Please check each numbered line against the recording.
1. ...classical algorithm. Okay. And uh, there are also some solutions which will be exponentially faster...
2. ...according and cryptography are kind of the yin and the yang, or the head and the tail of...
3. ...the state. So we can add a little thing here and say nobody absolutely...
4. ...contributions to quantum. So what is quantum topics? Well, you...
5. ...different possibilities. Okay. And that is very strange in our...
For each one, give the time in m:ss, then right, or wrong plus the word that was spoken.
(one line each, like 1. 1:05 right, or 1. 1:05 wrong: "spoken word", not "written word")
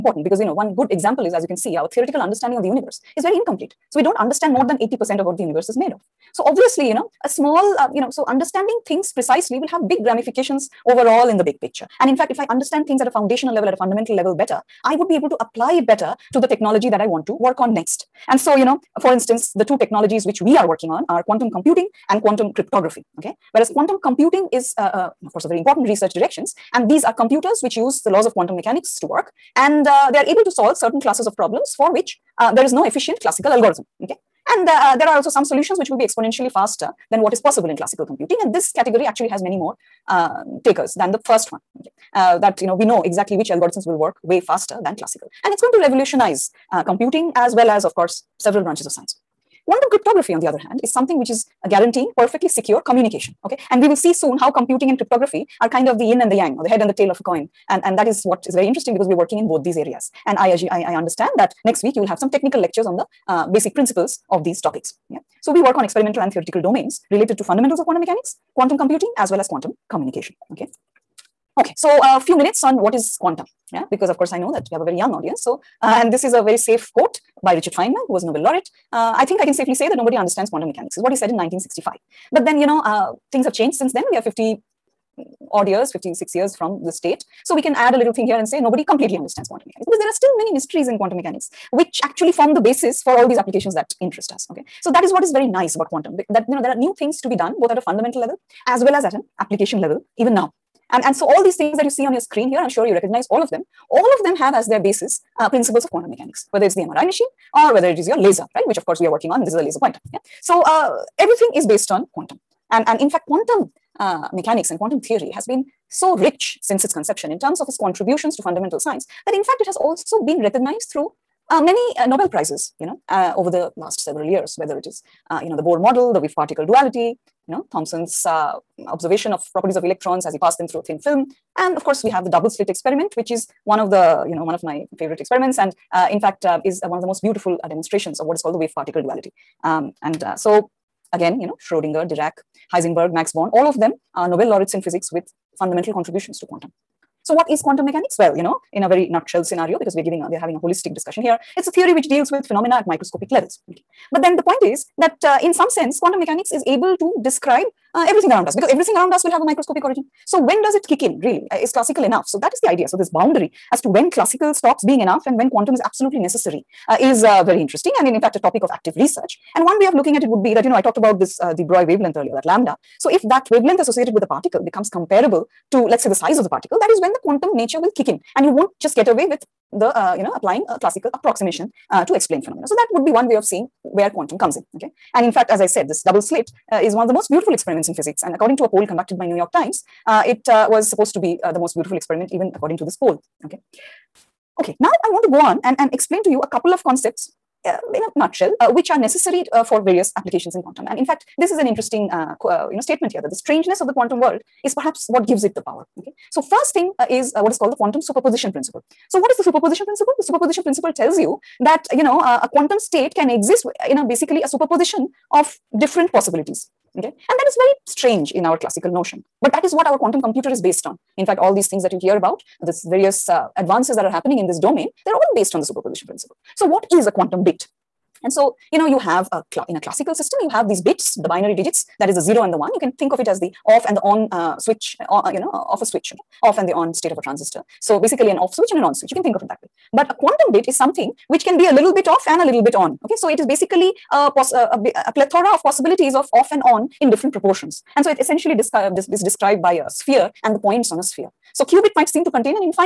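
1. 0:33 right
2. 0:54 wrong: "computing", not "according"
3. 1:26 wrong: "completely", not "absolutely"
4. 2:25 wrong: "mechanics", not "topics"
5. 3:35 right.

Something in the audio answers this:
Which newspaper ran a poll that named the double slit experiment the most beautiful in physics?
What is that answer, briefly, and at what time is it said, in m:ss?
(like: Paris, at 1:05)
New York Times, at 3:09.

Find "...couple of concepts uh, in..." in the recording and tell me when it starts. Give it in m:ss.
3:16.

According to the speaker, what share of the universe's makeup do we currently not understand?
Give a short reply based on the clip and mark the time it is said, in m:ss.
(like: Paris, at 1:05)
More than 80%, at 0:04.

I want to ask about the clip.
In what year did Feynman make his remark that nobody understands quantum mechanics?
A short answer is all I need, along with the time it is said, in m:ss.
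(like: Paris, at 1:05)
1965, at 1:21.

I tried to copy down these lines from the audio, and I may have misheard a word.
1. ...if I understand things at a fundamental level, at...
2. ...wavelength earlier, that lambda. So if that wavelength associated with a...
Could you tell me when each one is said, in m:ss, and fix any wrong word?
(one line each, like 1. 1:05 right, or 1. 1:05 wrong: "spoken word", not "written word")
1. 0:12 wrong: "foundational", not "fundamental"
2. 2:51 right.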